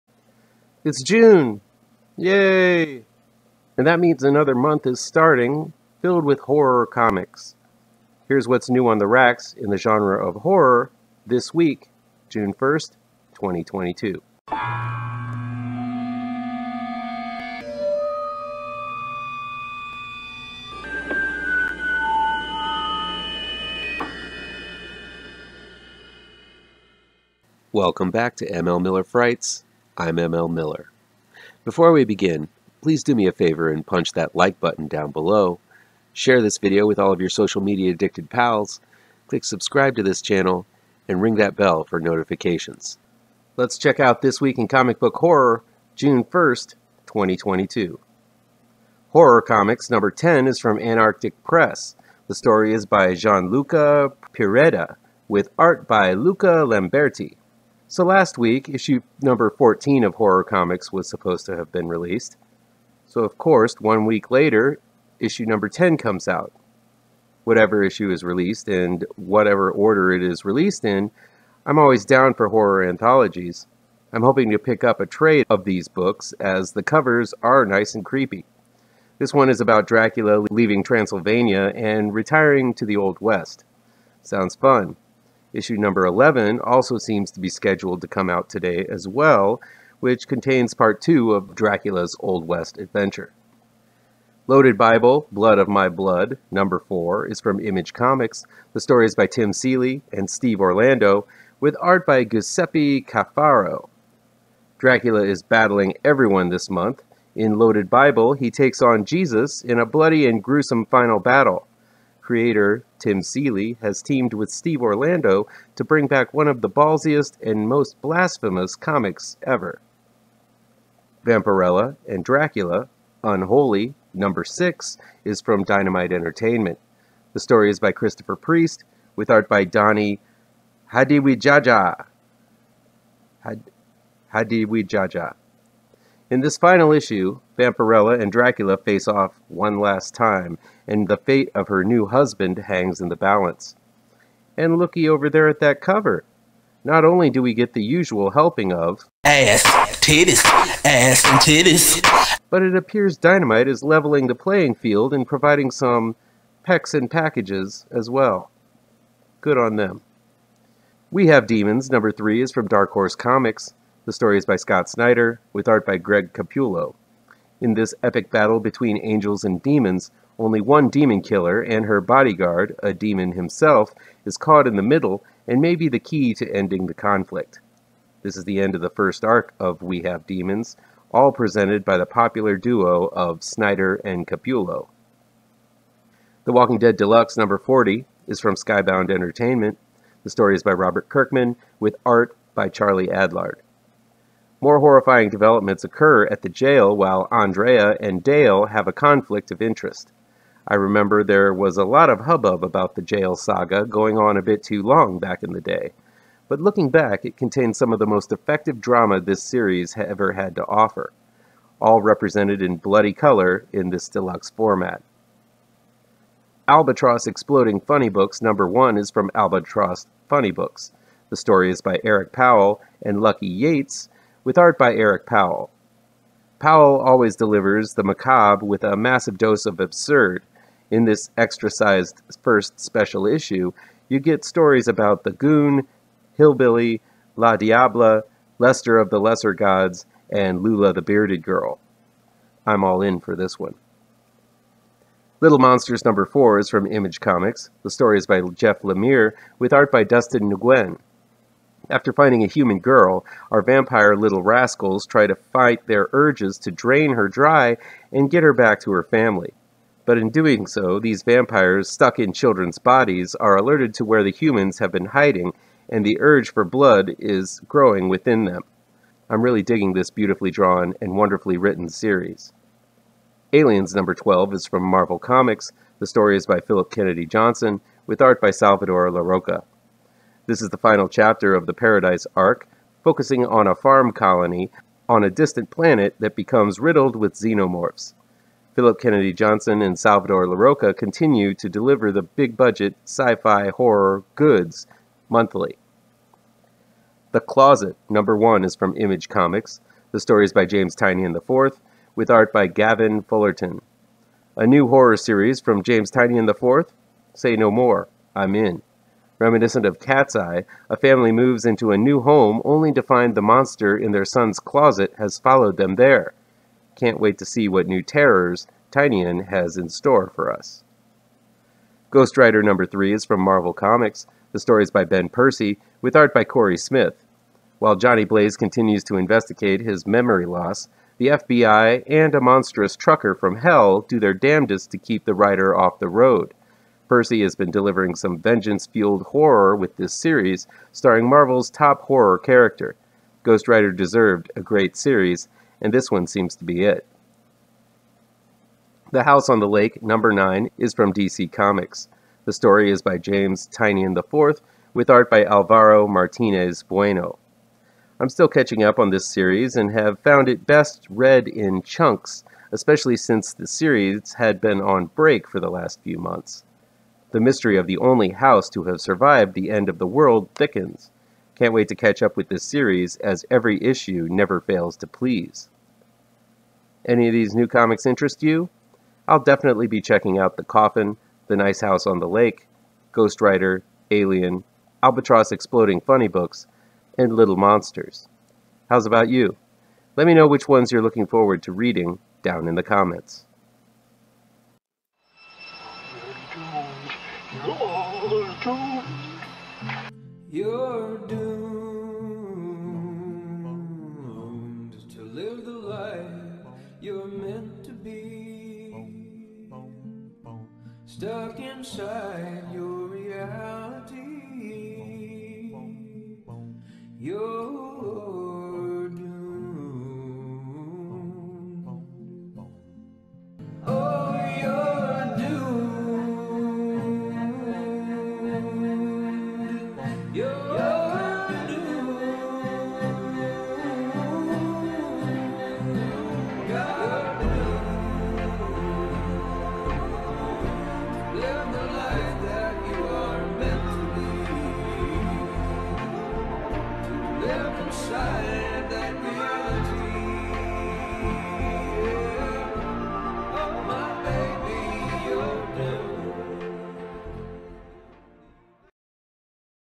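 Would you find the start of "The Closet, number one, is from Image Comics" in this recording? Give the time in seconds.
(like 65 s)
297 s.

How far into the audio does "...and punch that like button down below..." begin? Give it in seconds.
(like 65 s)
33 s.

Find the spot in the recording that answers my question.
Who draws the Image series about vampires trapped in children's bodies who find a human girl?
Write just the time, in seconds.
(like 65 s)
250 s.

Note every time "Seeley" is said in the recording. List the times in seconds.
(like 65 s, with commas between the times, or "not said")
99 s, 113 s.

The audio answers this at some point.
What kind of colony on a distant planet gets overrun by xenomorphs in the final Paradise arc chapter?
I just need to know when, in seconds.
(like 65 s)
283 s.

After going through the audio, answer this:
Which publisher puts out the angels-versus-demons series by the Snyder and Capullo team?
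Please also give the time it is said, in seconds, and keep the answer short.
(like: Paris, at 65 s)
Dark Horse Comics, at 162 s.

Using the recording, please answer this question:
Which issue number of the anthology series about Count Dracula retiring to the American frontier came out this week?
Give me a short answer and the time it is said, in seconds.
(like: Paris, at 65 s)
10, at 65 s.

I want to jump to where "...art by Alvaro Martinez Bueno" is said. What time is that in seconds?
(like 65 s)
355 s.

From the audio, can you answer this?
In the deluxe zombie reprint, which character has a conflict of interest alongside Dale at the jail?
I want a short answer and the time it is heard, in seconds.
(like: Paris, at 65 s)
Andrea, at 197 s.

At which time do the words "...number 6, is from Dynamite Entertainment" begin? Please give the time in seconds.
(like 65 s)
124 s.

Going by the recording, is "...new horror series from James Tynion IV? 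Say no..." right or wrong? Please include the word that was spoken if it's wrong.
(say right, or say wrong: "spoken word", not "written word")
right.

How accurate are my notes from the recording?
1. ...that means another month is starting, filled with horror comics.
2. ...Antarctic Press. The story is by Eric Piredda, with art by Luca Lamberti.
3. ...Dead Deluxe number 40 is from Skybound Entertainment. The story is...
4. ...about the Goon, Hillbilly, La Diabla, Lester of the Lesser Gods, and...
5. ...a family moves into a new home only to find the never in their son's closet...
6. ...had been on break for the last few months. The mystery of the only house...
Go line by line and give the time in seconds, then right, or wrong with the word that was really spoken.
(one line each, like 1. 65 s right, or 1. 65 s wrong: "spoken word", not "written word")
1. 3 s right
2. 50 s wrong: "Gianluca", not "Eric"
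3. 186 s right
4. 234 s right
5. 310 s wrong: "monster", not "never"
6. 364 s right.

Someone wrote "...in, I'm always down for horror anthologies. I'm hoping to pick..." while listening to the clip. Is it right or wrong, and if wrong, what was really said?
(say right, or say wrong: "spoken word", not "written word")
right.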